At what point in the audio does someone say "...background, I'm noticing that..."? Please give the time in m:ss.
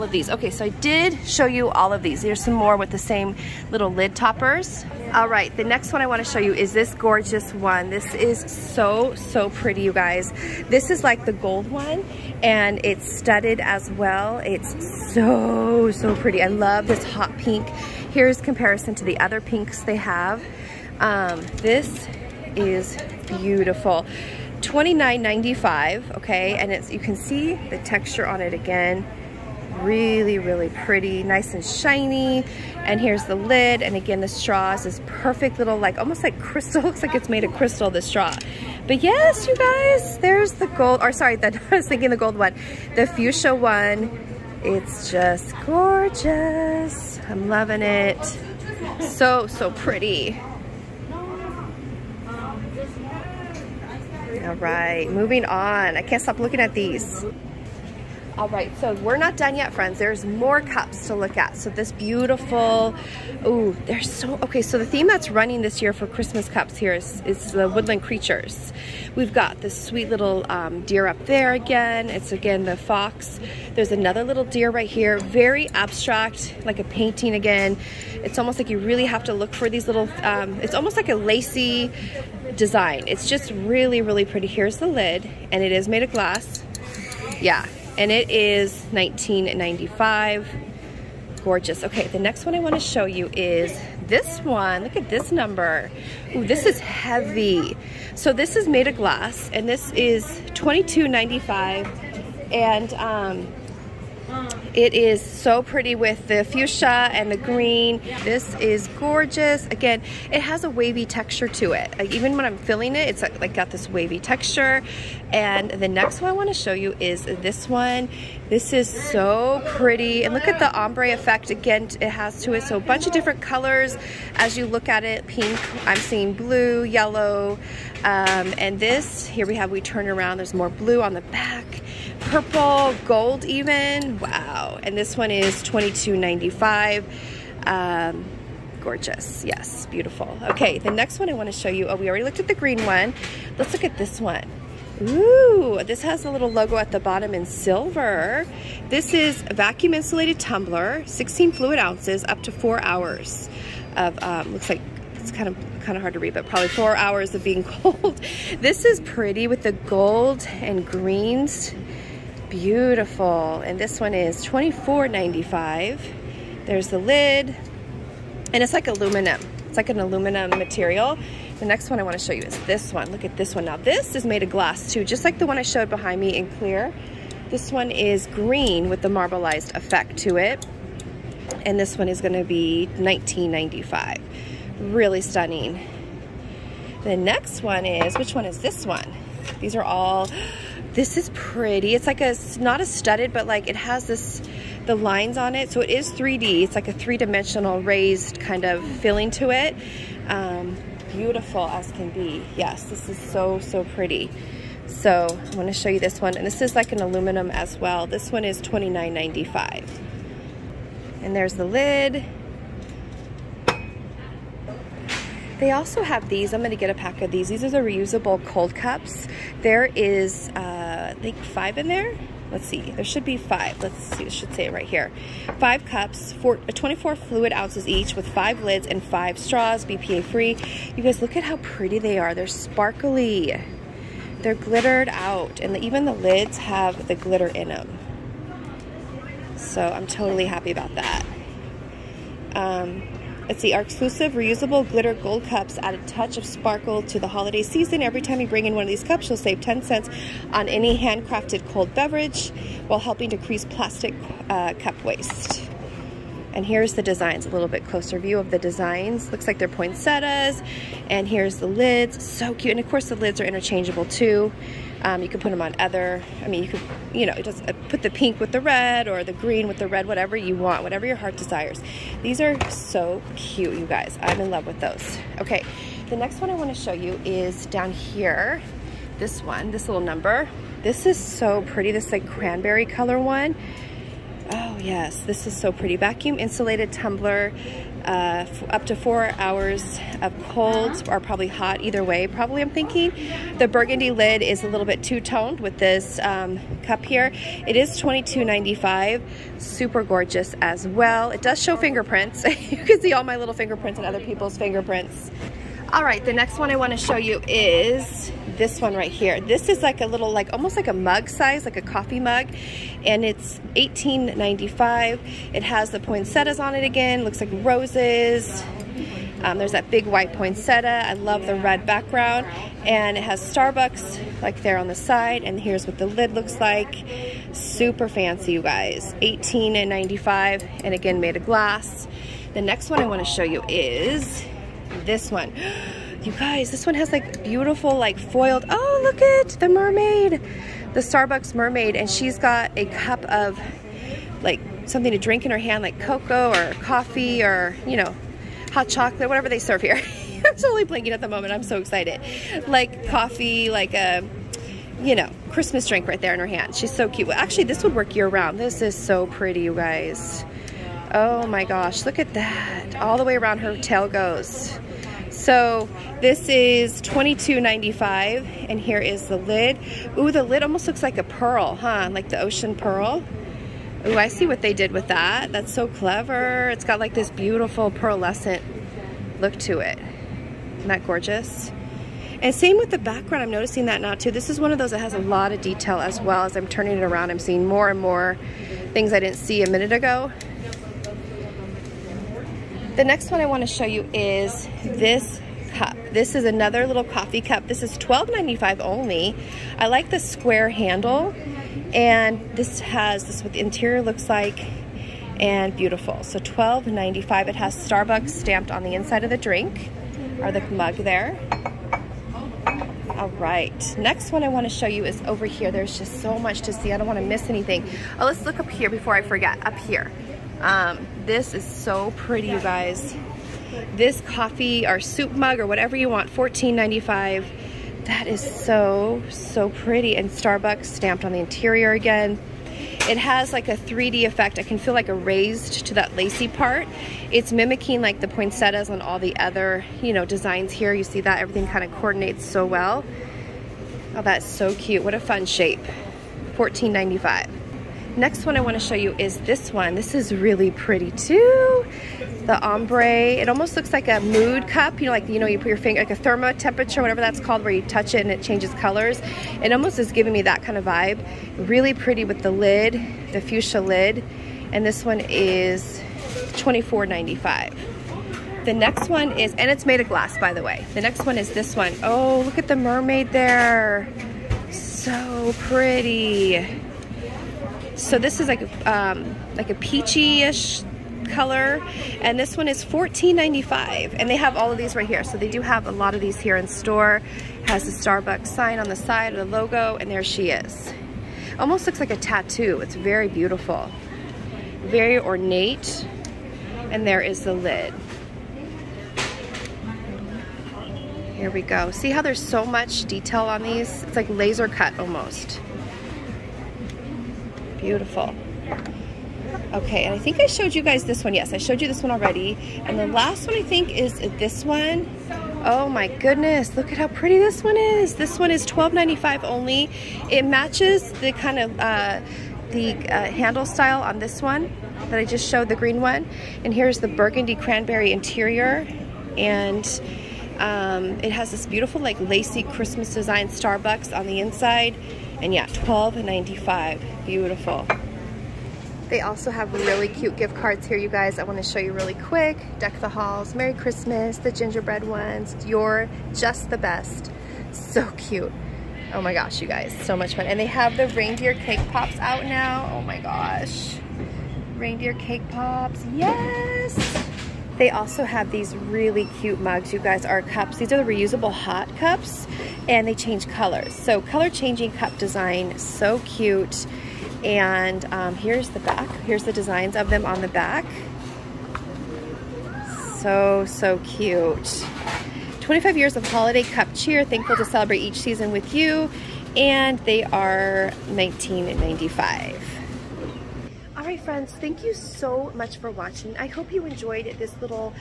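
6:22.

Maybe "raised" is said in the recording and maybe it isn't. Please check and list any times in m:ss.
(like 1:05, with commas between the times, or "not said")
3:17, 7:15.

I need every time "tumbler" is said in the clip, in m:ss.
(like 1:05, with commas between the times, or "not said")
2:30, 4:46.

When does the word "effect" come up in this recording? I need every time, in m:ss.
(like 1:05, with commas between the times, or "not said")
2:01, 2:59, 7:14.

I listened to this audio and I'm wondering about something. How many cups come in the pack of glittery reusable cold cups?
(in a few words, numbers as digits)
5.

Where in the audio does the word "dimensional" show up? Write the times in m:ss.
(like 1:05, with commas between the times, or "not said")
3:16.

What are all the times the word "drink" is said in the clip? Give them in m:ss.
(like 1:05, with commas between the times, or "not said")
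5:45, 5:55, 6:49.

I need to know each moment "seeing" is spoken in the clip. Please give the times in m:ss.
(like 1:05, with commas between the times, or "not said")
2:05, 6:27.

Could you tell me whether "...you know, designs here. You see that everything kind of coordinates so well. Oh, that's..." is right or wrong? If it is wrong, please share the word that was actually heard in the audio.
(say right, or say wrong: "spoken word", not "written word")
right.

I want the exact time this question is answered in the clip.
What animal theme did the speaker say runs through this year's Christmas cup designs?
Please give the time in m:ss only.
1:07.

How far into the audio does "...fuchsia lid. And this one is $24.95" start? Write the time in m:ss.
7:43.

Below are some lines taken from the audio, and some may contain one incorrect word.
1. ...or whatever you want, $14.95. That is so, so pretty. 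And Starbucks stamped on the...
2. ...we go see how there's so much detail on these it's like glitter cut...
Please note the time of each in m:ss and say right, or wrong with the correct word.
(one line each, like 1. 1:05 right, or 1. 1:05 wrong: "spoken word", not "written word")
1. 7:05 right
2. 8:21 wrong: "laser", not "glitter".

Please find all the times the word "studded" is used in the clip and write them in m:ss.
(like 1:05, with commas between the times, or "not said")
0:13, 3:12.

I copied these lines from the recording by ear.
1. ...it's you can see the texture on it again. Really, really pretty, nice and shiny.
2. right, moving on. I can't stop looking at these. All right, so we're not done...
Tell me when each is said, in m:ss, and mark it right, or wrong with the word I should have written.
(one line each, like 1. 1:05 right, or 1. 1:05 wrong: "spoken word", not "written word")
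1. 0:26 right
2. 0:54 right.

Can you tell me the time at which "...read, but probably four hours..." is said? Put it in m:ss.
2:36.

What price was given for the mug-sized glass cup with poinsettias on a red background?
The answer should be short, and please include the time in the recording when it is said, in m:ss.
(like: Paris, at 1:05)
$18.95, at 5:13.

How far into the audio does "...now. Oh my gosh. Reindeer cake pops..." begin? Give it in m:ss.
9:12.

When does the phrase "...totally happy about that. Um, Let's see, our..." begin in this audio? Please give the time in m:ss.
4:00.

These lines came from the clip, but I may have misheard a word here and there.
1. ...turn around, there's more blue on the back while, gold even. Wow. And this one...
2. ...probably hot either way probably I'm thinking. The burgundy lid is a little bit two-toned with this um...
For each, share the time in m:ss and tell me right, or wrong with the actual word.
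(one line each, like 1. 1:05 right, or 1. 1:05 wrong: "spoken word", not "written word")
1. 2:09 wrong: "purple", not "while"
2. 4:51 right.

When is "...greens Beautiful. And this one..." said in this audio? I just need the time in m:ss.
2:40.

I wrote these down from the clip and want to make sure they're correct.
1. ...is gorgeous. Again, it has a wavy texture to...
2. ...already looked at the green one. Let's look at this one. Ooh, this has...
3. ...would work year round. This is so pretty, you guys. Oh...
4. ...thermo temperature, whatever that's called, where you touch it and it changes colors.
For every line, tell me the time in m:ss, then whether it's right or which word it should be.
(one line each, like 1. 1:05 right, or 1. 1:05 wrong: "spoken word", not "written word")
1. 1:48 right
2. 2:22 right
3. 5:57 right
4. 7:36 right.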